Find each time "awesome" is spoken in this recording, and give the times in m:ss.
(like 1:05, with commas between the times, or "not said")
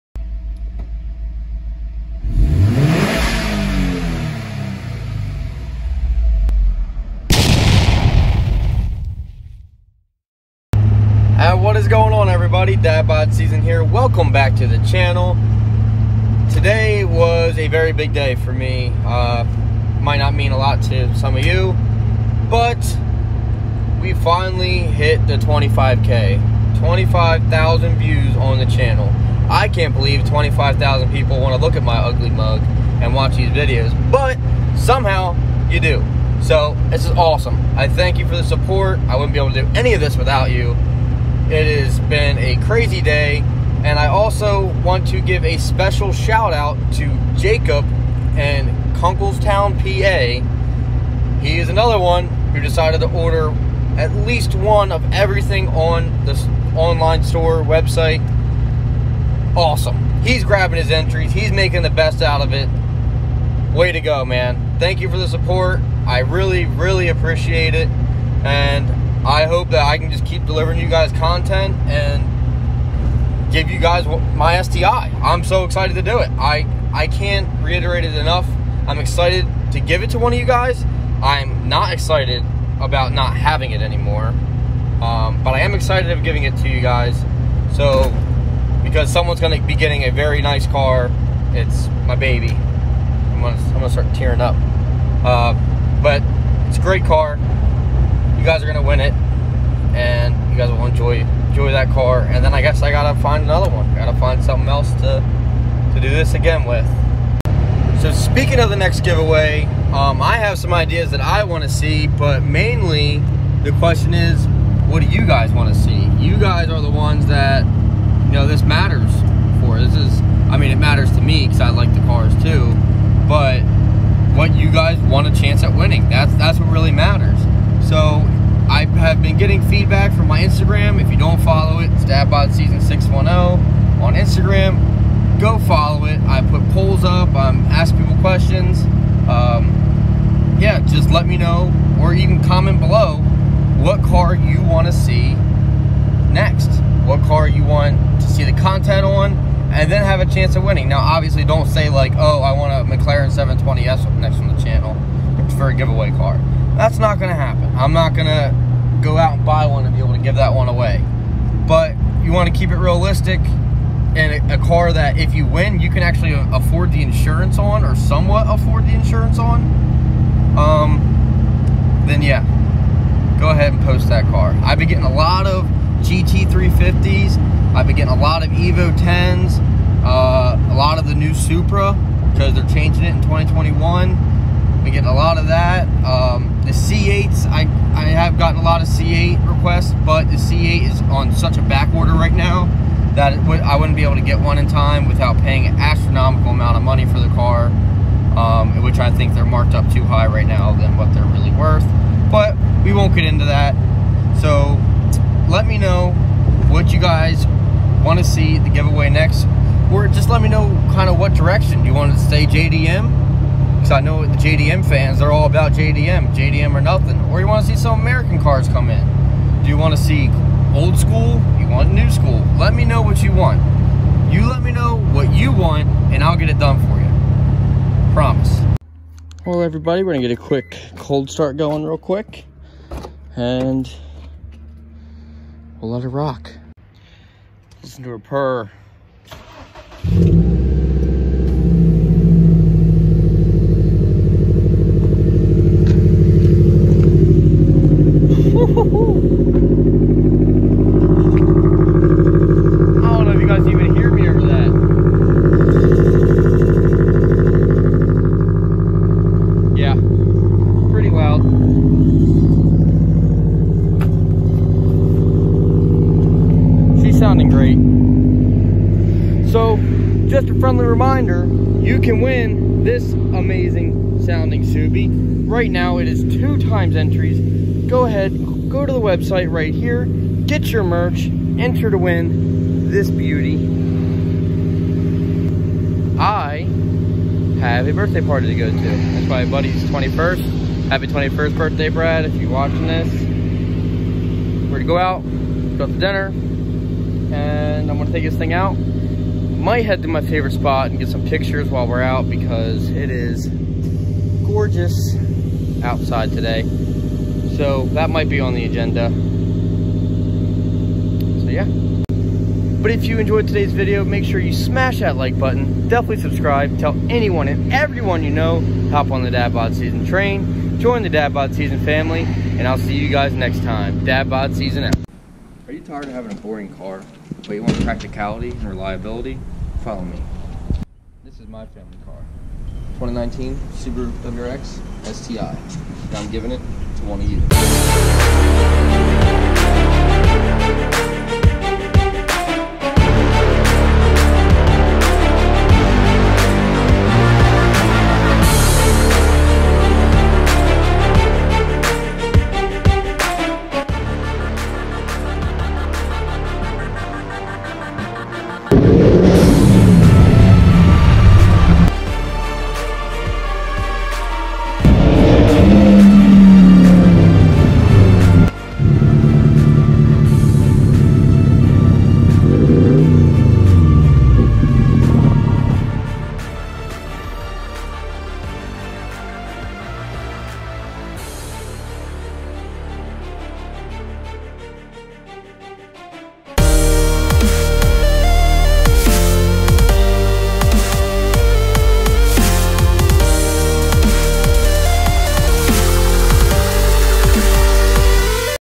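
0:37, 0:59.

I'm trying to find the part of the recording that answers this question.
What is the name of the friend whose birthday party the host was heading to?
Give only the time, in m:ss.
4:51.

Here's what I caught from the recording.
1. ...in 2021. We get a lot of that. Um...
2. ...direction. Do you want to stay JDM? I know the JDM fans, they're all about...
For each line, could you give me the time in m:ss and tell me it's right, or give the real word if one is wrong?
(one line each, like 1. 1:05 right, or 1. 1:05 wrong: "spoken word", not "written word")
1. 3:03 right
2. 3:31 right.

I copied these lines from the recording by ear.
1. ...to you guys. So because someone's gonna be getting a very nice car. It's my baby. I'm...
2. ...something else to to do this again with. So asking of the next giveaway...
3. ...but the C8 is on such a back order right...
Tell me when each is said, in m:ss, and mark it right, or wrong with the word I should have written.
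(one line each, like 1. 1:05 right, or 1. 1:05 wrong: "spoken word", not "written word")
1. 1:26 right
2. 1:44 wrong: "speaking", not "asking"
3. 3:10 right.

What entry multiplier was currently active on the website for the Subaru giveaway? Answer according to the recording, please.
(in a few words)
2 times.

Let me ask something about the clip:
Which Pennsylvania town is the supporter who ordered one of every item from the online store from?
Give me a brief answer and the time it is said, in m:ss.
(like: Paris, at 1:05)
Kunkelstown, at 0:48.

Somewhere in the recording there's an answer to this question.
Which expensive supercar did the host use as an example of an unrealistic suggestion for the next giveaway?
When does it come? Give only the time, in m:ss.
2:32.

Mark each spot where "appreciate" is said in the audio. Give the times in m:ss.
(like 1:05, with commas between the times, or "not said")
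1:07.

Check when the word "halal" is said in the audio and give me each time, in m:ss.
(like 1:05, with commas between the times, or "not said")
not said.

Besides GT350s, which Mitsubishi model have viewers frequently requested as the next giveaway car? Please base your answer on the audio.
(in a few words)
Evo 10.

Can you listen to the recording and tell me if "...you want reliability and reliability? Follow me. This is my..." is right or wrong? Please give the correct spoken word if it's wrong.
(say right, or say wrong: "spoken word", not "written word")
wrong: "practicality", not "reliability".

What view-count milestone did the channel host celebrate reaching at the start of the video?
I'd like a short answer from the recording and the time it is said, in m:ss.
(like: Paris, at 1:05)
25,000, at 0:26.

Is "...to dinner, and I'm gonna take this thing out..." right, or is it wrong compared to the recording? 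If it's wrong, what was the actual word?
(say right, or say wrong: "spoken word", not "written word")
right.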